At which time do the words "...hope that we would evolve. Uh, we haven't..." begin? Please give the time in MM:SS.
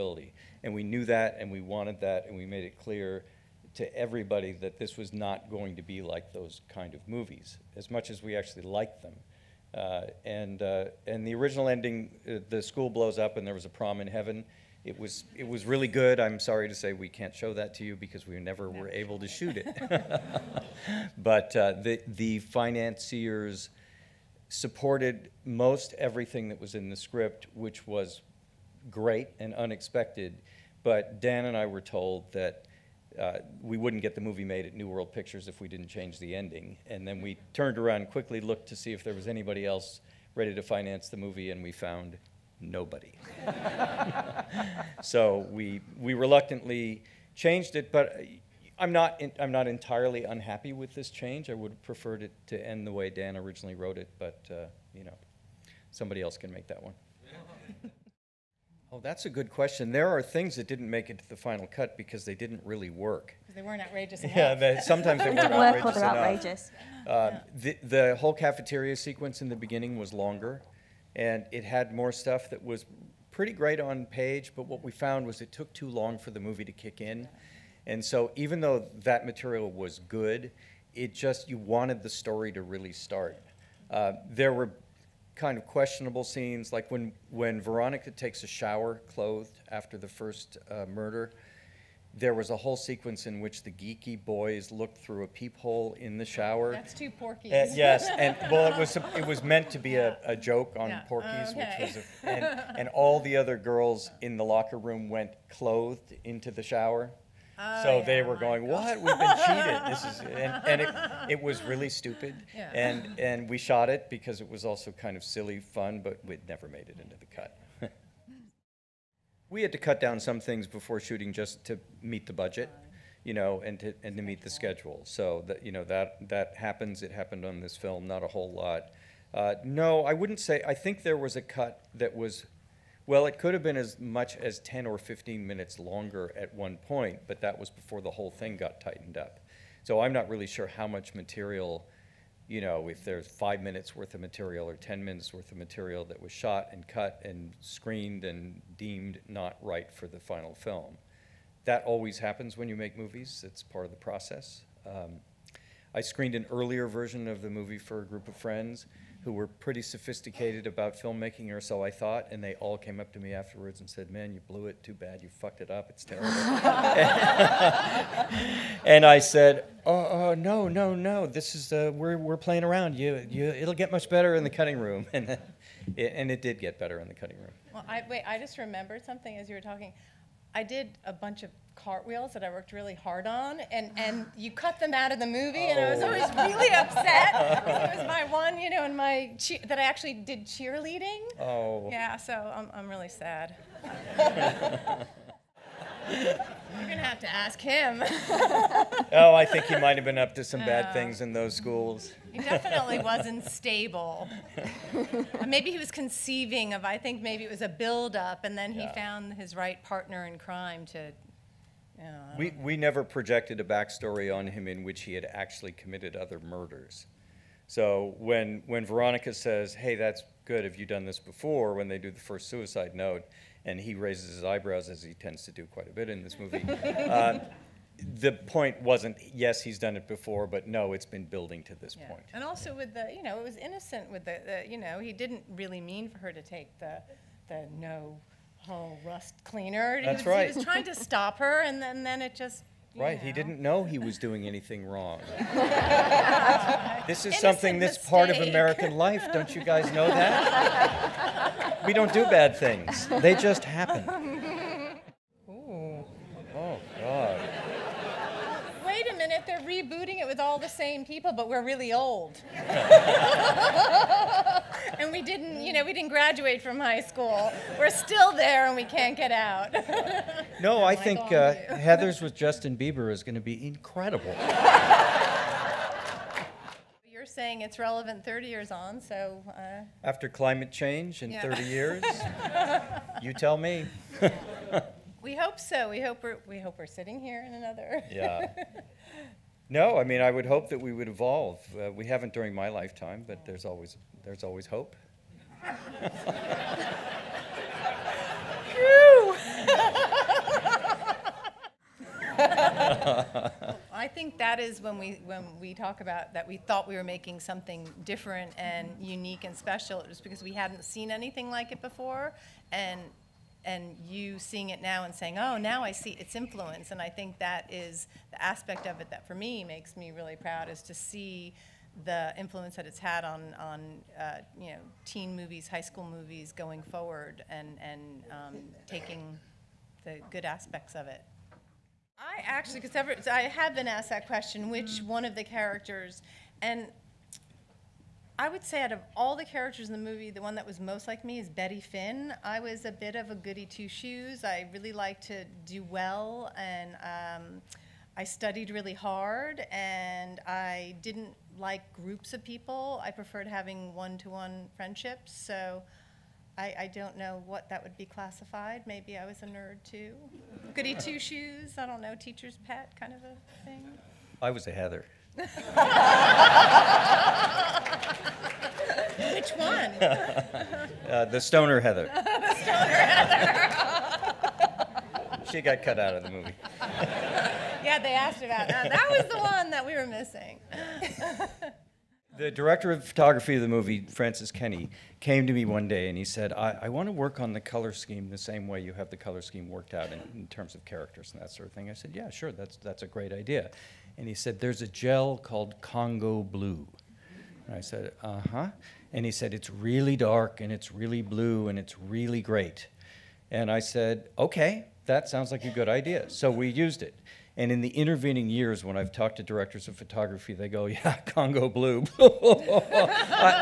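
04:50.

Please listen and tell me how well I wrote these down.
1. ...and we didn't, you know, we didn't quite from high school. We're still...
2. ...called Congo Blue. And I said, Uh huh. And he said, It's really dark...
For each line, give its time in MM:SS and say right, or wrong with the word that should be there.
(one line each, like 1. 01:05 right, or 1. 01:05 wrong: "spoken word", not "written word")
1. 04:24 wrong: "graduate", not "quite"
2. 06:35 right.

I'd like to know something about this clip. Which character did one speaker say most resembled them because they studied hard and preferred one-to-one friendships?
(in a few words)
Betty Finn.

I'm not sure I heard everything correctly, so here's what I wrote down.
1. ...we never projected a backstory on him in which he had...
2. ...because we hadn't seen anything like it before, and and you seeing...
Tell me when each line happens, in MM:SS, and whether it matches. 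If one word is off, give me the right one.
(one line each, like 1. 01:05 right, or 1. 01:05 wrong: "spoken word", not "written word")
1. 03:32 right
2. 05:10 right.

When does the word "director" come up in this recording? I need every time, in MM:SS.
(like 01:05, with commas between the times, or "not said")
06:22, 06:49.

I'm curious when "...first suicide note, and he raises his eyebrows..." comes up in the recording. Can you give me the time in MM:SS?
03:42.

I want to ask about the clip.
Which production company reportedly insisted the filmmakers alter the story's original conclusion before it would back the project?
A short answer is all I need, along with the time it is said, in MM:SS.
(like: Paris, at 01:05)
New World Pictures, at 00:34.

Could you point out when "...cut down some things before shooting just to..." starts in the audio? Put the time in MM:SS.
01:59.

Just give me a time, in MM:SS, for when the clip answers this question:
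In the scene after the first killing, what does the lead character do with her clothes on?
01:28.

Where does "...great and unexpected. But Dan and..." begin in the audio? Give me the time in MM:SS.
00:28.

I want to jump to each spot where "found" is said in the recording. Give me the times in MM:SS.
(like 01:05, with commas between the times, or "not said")
00:41, 01:14, 03:28.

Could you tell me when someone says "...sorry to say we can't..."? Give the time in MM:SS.
00:16.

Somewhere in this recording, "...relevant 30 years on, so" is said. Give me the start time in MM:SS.
04:37.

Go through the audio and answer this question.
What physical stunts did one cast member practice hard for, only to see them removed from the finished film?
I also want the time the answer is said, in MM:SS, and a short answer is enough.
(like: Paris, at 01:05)
cartwheels, at 03:01.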